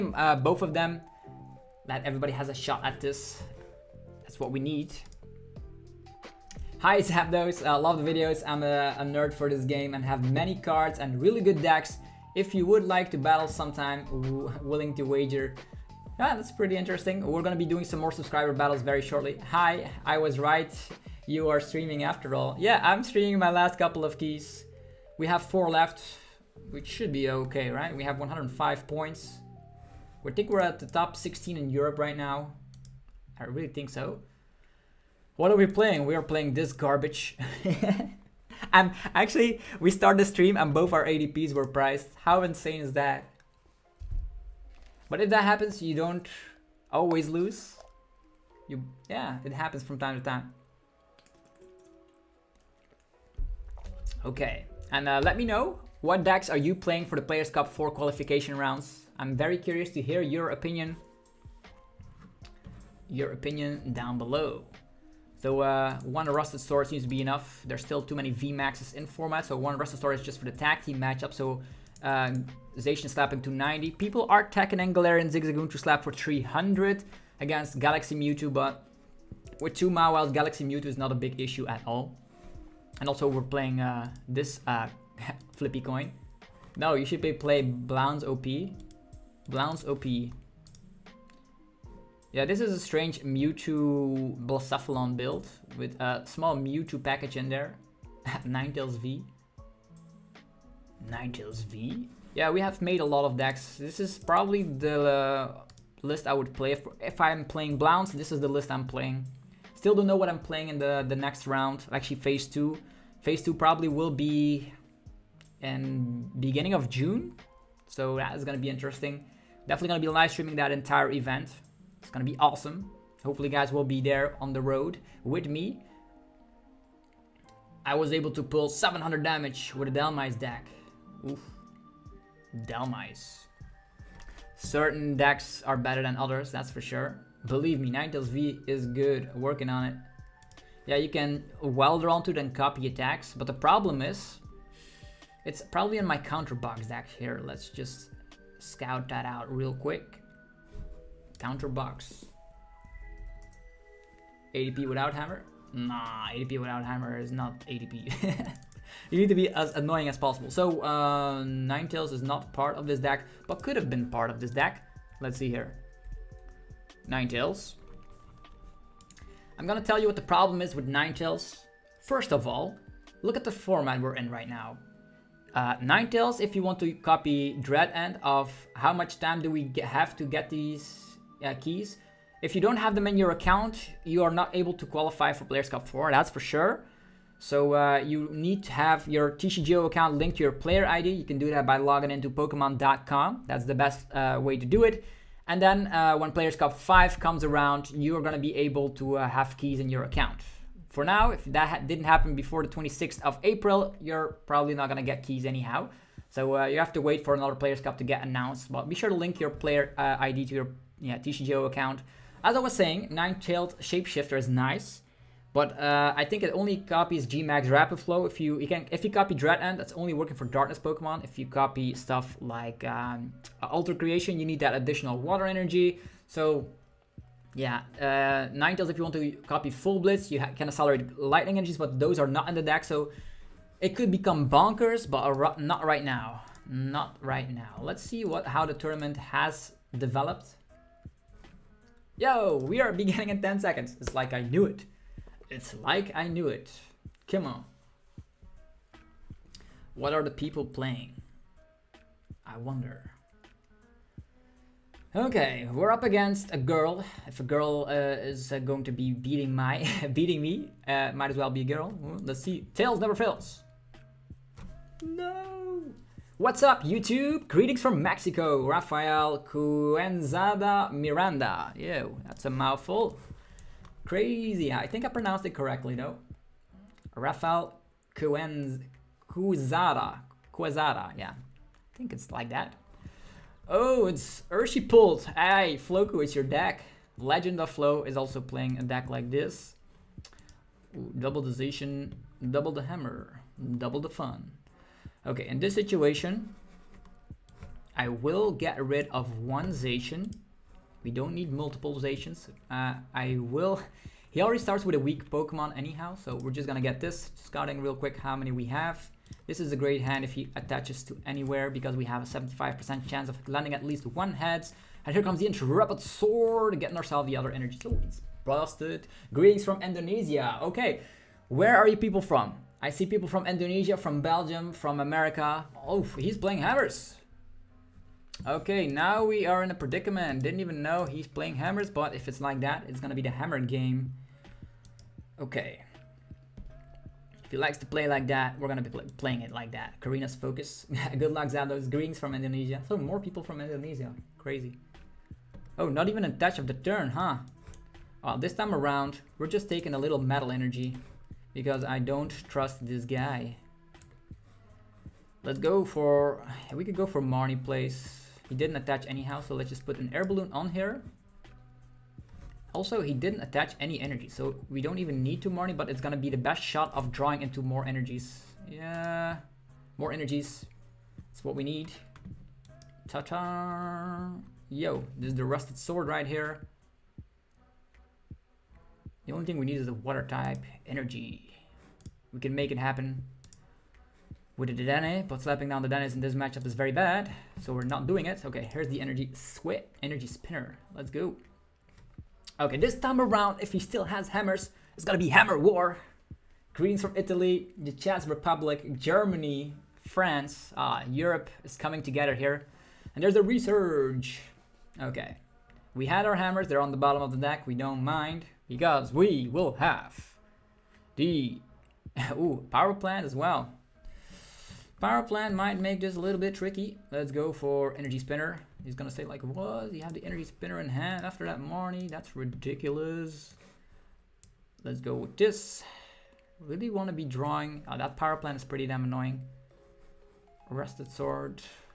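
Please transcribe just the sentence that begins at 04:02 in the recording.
Yo, we are beginning in 10 seconds.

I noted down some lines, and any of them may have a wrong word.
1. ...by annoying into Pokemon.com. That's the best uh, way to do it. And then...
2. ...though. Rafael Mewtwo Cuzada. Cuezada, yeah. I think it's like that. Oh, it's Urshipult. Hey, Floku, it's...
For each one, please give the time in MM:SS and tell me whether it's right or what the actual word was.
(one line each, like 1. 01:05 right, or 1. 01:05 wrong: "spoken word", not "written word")
1. 03:11 wrong: "logging", not "annoying"
2. 04:35 wrong: "Cuenz", not "Mewtwo".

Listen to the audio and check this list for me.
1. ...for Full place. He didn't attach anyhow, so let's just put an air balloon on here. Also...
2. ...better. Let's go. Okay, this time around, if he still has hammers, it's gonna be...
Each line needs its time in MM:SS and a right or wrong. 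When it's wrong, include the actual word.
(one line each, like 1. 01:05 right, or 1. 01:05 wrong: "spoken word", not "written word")
1. 05:57 wrong: "Marnie", not "Full"
2. 06:30 wrong: "spinner", not "better".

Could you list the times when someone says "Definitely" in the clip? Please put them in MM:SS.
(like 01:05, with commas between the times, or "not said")
01:59.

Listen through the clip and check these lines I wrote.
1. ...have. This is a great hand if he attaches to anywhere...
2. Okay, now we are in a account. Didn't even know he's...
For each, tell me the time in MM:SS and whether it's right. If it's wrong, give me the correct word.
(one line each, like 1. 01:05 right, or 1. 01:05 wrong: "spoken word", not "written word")
1. 05:08 right
2. 05:28 wrong: "predicament", not "account".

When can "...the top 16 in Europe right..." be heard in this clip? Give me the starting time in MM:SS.
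00:30.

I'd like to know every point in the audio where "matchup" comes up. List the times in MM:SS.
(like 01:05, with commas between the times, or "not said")
01:10, 06:26.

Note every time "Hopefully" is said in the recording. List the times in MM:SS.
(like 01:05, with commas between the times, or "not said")
02:03.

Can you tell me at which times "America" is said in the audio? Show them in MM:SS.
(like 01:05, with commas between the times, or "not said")
05:24.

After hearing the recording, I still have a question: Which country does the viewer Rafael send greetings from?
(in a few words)
Mexico.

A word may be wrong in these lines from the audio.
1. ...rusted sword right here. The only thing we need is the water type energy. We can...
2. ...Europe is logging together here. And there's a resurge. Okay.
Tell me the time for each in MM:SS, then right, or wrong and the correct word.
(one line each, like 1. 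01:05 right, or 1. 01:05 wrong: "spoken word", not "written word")
1. 06:15 right
2. 06:41 wrong: "coming", not "logging".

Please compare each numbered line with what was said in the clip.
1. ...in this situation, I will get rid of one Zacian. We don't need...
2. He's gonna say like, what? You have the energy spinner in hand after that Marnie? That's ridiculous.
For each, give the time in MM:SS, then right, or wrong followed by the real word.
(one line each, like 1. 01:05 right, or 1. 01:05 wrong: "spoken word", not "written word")
1. 04:55 right
2. 06:58 right.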